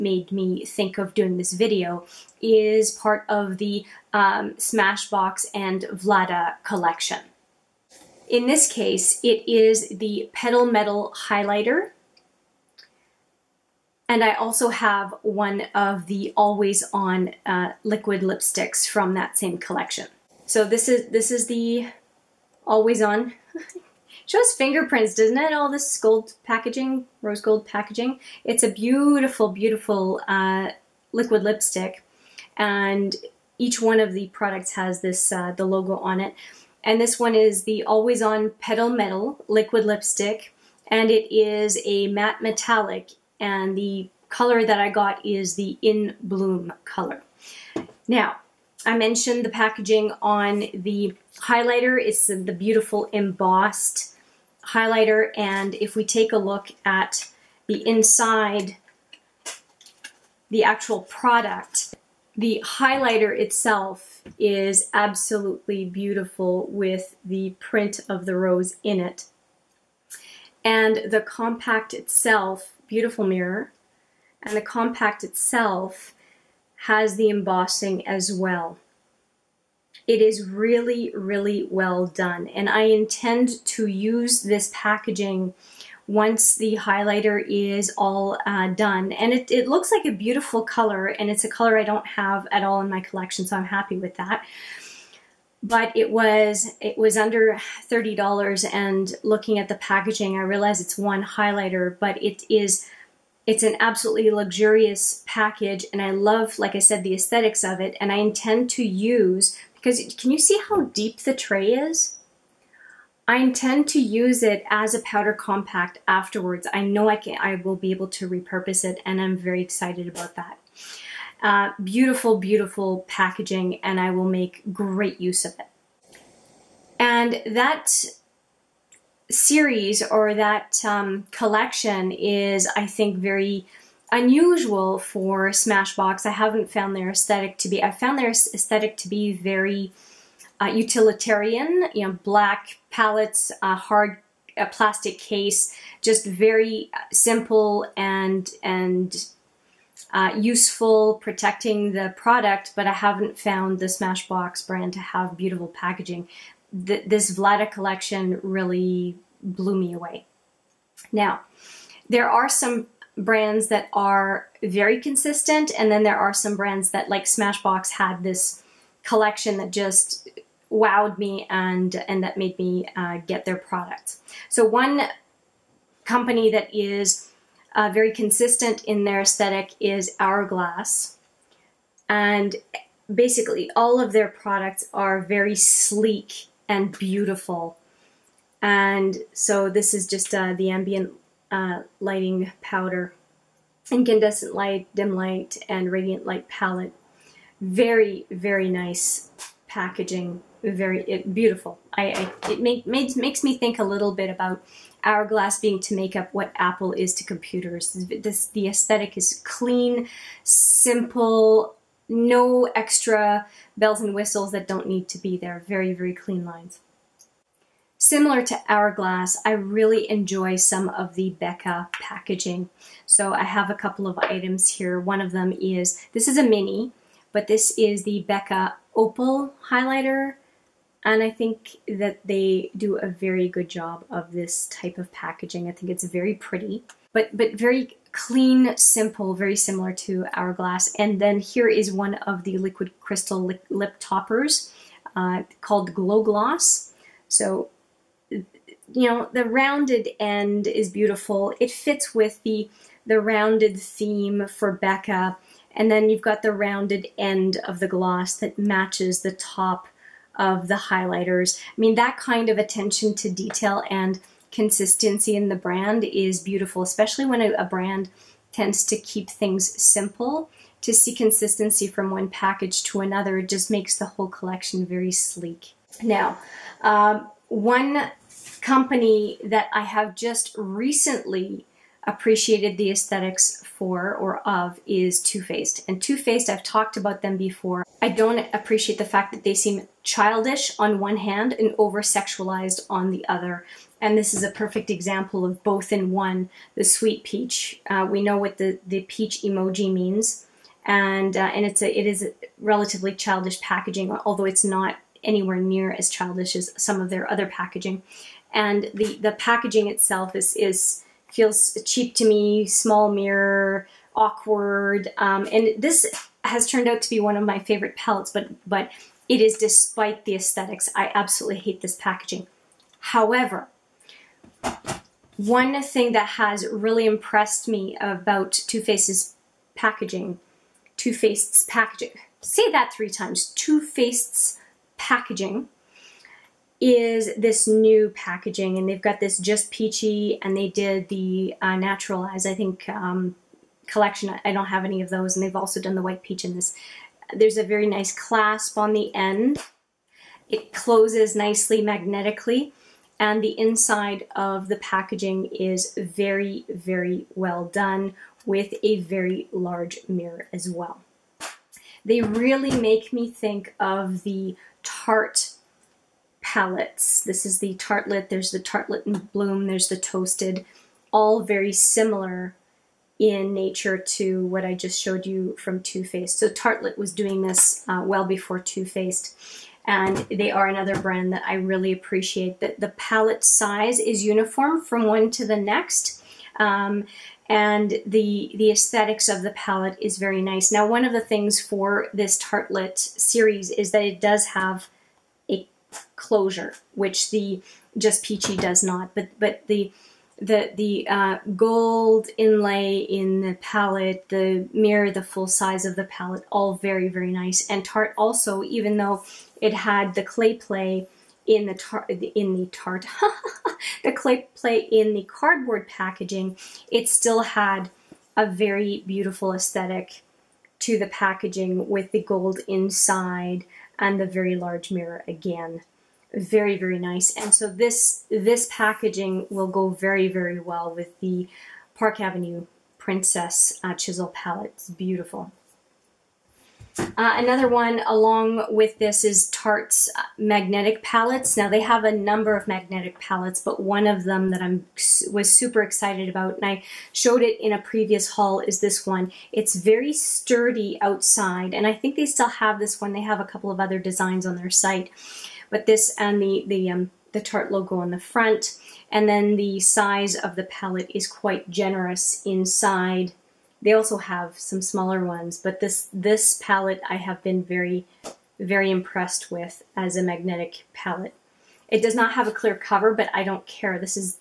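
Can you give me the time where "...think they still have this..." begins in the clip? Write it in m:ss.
7:31.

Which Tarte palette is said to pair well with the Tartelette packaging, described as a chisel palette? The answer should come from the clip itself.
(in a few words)
Park Avenue Princess.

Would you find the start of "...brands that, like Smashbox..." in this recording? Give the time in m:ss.
2:46.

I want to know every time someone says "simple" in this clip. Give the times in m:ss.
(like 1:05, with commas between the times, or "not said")
2:27, 3:30, 3:58, 4:29.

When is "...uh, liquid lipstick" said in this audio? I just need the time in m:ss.
0:30.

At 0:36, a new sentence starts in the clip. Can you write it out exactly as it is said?
And this one is the Always On Petal Metal Liquid Lipstick.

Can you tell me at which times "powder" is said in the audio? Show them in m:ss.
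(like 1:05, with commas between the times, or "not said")
1:55, 3:12.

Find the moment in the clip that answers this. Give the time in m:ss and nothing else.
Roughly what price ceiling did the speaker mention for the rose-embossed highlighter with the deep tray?
1:37.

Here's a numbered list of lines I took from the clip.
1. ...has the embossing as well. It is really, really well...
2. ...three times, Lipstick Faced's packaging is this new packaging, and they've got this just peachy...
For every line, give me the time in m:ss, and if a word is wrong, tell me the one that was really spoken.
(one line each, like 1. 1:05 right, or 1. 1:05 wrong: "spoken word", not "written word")
1. 1:16 right
2. 5:32 wrong: "Too", not "Lipstick".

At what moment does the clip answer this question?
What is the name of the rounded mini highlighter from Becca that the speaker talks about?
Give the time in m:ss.
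3:48.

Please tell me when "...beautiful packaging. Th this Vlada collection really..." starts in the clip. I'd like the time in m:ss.
2:35.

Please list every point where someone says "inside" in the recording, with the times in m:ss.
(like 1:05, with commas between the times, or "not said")
0:57, 5:53, 7:02, 7:42.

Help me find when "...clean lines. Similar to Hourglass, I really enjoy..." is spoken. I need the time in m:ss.
3:36.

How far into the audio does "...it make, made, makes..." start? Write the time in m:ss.
3:22.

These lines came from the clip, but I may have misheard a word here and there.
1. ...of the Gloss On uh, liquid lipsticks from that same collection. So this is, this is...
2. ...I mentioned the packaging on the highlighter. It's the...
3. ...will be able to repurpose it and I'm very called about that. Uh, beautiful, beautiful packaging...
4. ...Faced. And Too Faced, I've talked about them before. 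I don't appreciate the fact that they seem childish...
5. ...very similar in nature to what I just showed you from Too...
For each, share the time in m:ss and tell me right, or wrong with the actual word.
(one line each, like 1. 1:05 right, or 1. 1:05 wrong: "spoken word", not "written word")
1. 0:15 wrong: "Always", not "Gloss"
2. 0:48 right
3. 1:57 wrong: "excited", not "called"
4. 4:45 right
5. 6:11 right.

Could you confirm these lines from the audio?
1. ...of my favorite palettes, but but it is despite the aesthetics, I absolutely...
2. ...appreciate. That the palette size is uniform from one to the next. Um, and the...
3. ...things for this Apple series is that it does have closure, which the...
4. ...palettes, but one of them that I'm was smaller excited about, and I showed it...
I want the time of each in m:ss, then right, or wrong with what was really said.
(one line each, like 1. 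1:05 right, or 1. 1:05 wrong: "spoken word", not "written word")
1. 5:17 right
2. 6:21 right
3. 6:31 wrong: "Tartelette", not "Apple"
4. 7:23 wrong: "super", not "smaller".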